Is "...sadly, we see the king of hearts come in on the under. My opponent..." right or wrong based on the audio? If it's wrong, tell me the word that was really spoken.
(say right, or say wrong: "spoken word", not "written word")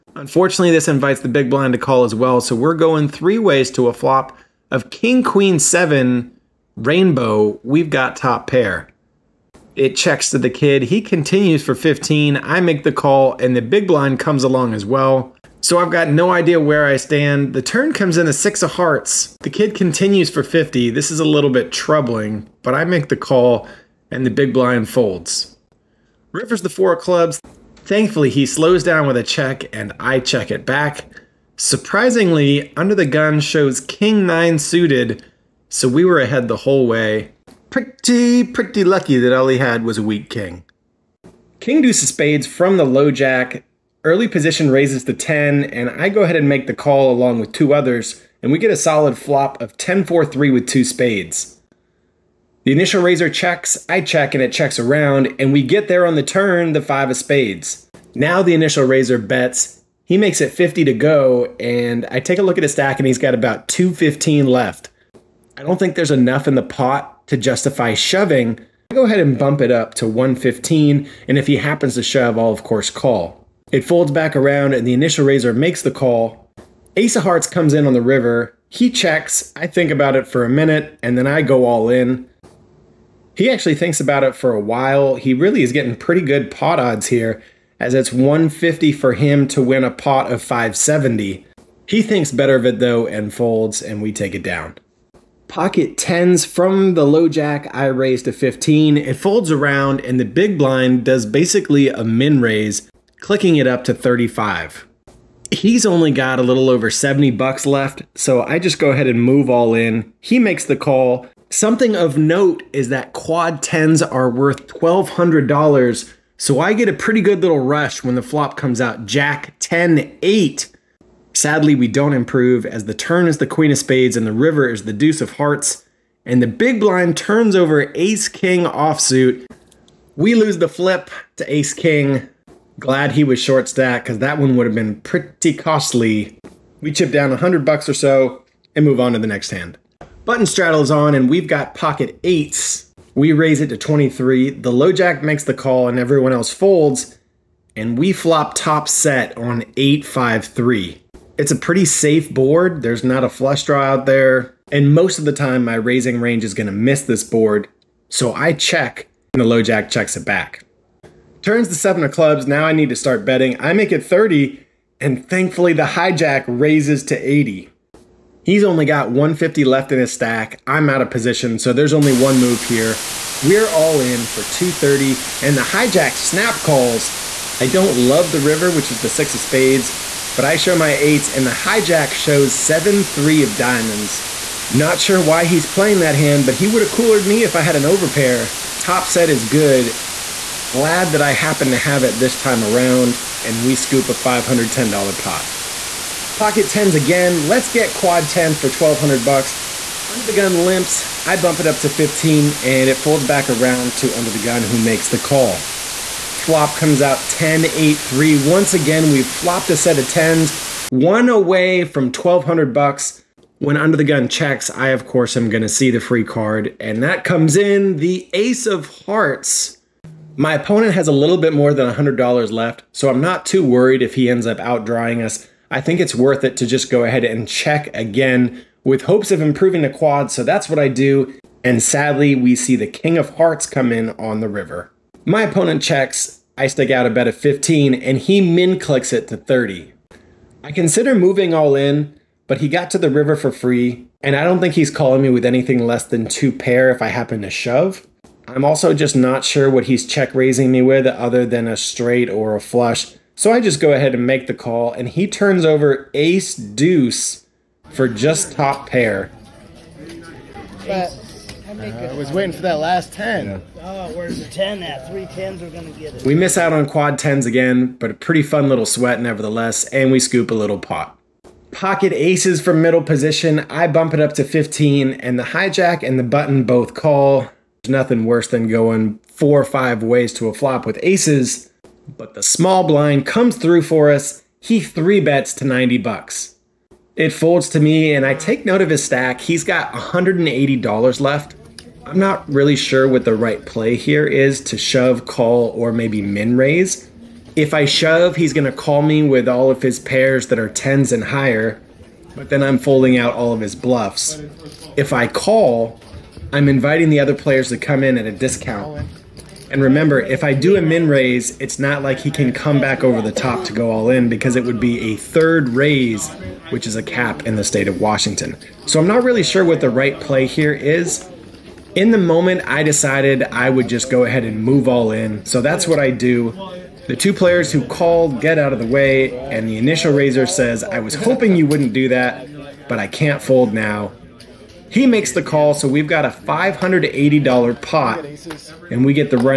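wrong: "river", not "under".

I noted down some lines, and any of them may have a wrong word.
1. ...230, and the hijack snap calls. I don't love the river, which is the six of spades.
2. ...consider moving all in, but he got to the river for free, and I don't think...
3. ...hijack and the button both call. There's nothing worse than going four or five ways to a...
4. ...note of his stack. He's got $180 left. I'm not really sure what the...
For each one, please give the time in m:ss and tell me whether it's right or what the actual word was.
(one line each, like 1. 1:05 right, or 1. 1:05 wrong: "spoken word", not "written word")
1. 2:54 right
2. 4:00 right
3. 4:35 right
4. 4:48 right.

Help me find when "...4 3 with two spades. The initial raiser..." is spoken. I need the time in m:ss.
0:50.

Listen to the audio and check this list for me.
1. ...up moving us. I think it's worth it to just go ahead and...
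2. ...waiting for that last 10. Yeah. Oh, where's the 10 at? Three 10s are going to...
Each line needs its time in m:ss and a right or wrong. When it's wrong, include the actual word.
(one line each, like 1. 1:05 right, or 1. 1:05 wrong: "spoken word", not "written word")
1. 3:44 wrong: "outdrawing", not "moving"
2. 4:22 right.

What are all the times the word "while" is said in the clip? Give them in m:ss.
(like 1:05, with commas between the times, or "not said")
1:24.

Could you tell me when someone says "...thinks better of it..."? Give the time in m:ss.
1:32.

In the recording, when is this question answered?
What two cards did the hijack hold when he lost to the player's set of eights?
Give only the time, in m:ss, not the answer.
3:02.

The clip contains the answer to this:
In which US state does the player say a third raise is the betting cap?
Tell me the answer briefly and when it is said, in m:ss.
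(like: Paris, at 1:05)
Washington, at 5:18.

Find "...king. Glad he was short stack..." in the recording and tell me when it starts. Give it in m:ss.
2:11.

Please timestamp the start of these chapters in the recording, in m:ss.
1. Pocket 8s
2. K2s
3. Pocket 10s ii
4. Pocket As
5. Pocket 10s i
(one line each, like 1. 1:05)
1. 2:21
2. 0:42
3. 3:18
4. 4:34
5. 1:38.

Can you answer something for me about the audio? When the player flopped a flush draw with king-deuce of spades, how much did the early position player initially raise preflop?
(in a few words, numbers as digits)
10.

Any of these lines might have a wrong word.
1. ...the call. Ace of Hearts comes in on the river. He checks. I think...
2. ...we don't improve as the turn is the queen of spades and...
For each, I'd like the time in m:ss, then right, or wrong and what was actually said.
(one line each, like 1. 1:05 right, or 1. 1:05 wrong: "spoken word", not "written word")
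1. 1:15 right
2. 2:01 right.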